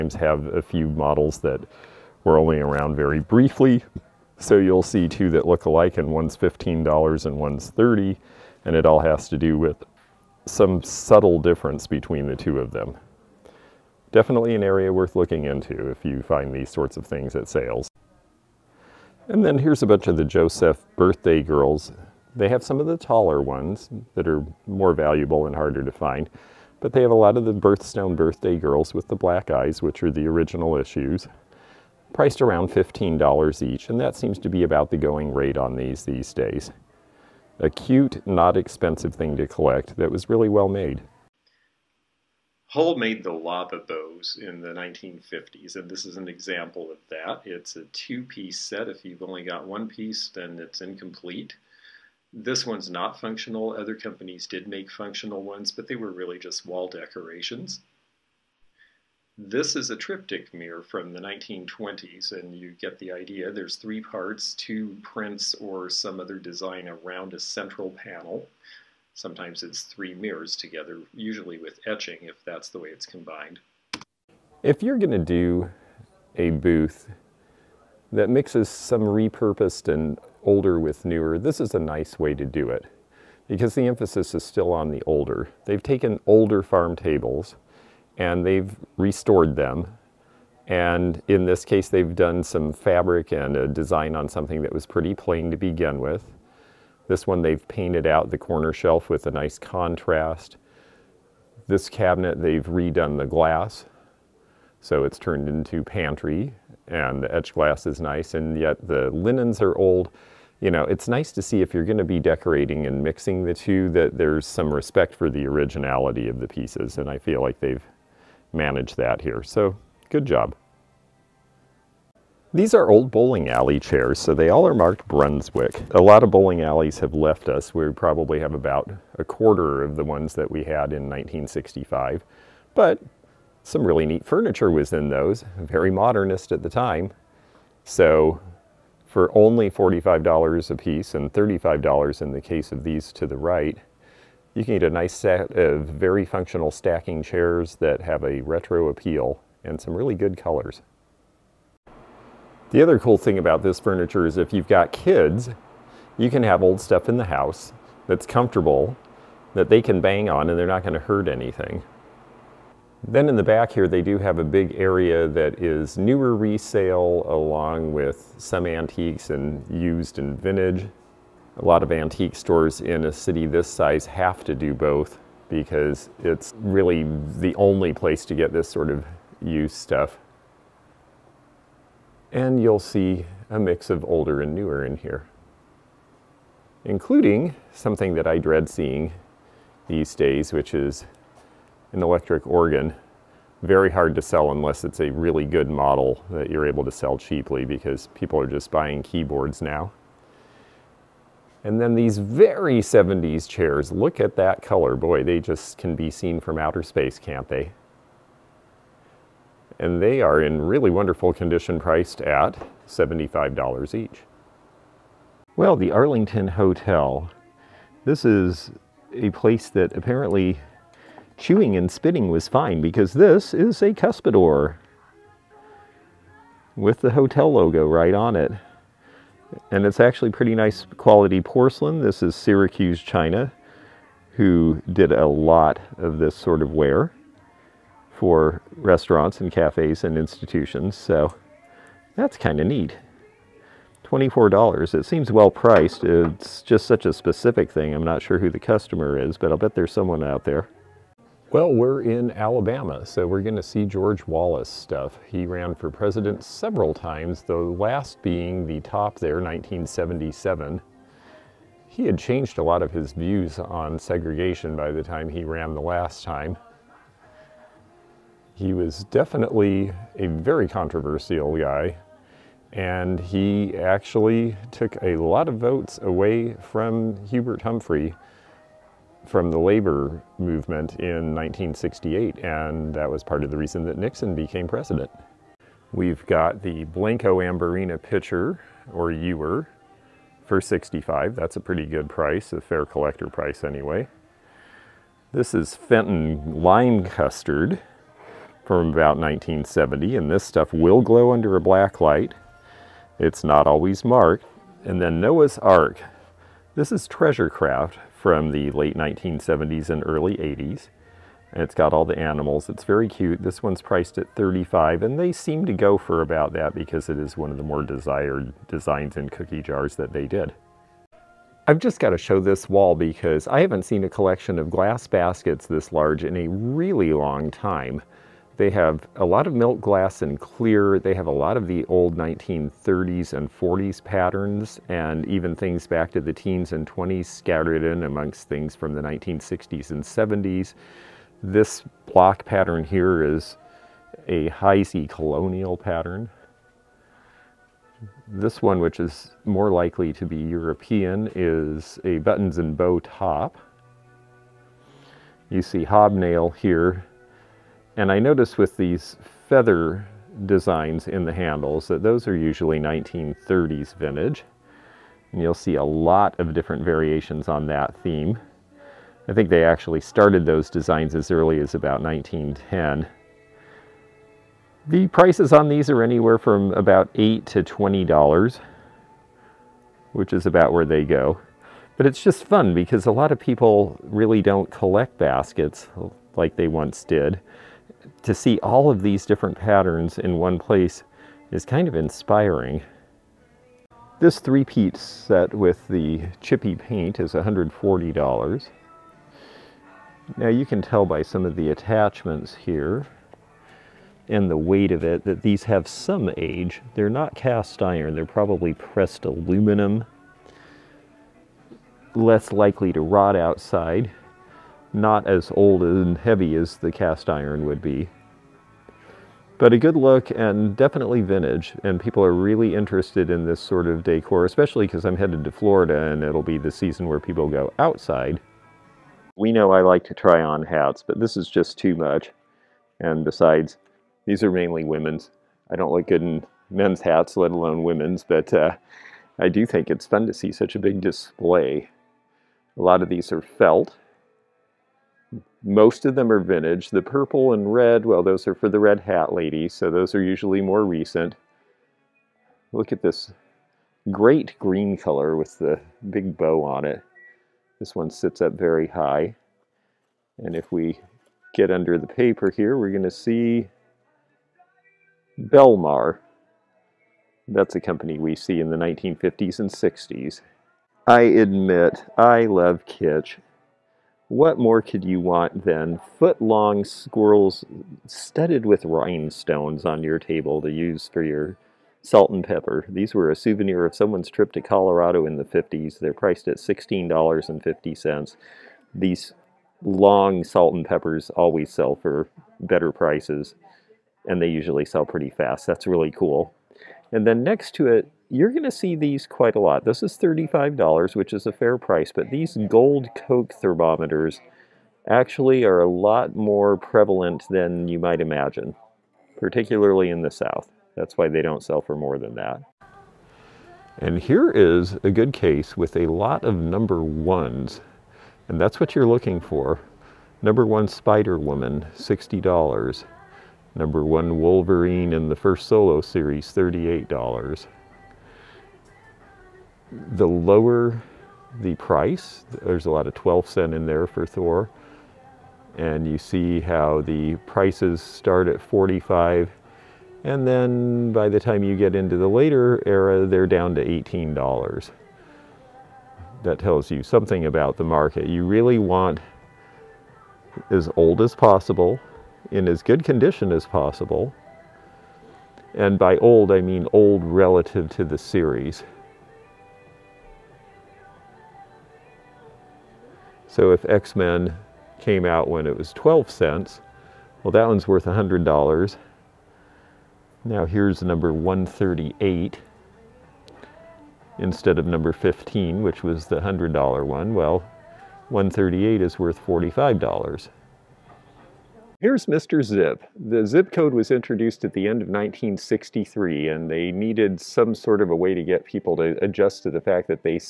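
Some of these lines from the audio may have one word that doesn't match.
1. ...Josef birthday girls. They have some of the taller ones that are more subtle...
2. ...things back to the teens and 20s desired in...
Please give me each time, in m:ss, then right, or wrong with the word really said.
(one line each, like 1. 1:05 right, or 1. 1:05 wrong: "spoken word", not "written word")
1. 0:20 wrong: "valuable", not "subtle"
2. 5:35 wrong: "scattered", not "desired".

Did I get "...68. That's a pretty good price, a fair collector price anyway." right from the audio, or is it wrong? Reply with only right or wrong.
wrong.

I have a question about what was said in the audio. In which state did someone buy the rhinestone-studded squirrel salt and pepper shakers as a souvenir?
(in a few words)
Colorado.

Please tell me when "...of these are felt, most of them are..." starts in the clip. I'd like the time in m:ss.
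7:23.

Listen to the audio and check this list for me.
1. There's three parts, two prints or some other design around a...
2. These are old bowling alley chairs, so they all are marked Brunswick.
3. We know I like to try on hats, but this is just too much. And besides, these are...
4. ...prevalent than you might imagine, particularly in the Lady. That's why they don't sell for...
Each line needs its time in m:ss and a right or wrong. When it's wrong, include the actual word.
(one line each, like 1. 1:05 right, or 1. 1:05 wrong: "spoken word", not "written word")
1. 1:03 right
2. 2:02 right
3. 7:09 right
4. 8:26 wrong: "South", not "Lady".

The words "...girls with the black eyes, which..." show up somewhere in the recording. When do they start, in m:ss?
0:28.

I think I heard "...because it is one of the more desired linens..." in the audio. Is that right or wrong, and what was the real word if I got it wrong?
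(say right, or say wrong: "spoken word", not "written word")
wrong: "designs", not "linens".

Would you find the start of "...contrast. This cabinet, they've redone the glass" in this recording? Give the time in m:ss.
1:39.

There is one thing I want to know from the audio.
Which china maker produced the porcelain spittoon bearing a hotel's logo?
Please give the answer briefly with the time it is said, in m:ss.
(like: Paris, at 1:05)
Syracuse China, at 3:52.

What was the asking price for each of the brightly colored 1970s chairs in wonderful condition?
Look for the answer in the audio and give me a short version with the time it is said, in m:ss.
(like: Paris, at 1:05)
$75, at 3:32.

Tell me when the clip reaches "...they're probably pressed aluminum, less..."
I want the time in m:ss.
6:48.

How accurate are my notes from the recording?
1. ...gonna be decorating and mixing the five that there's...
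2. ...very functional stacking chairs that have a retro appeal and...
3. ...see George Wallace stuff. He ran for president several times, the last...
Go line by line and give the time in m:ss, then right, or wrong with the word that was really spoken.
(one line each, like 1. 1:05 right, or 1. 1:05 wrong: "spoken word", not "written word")
1. 1:51 wrong: "two", not "five"
2. 2:25 right
3. 4:13 right.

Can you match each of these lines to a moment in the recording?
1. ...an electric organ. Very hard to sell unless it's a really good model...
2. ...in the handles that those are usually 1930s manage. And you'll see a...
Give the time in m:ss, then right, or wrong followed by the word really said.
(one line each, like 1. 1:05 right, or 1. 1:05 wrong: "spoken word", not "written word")
1. 3:11 right
2. 6:01 wrong: "vintage", not "manage".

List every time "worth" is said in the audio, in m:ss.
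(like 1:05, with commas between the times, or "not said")
0:14, 9:27, 9:39.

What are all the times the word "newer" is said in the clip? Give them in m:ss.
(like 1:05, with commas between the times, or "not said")
1:21, 2:45, 3:04.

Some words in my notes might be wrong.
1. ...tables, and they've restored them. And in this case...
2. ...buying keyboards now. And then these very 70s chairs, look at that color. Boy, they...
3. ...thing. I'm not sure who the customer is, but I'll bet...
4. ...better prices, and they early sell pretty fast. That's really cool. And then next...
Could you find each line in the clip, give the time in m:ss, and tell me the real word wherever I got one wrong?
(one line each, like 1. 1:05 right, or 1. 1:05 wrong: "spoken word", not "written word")
1. 1:26 right
2. 3:18 right
3. 4:07 right
4. 8:12 wrong: "usually", not "early".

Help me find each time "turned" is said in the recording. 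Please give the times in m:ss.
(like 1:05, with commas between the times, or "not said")
1:45.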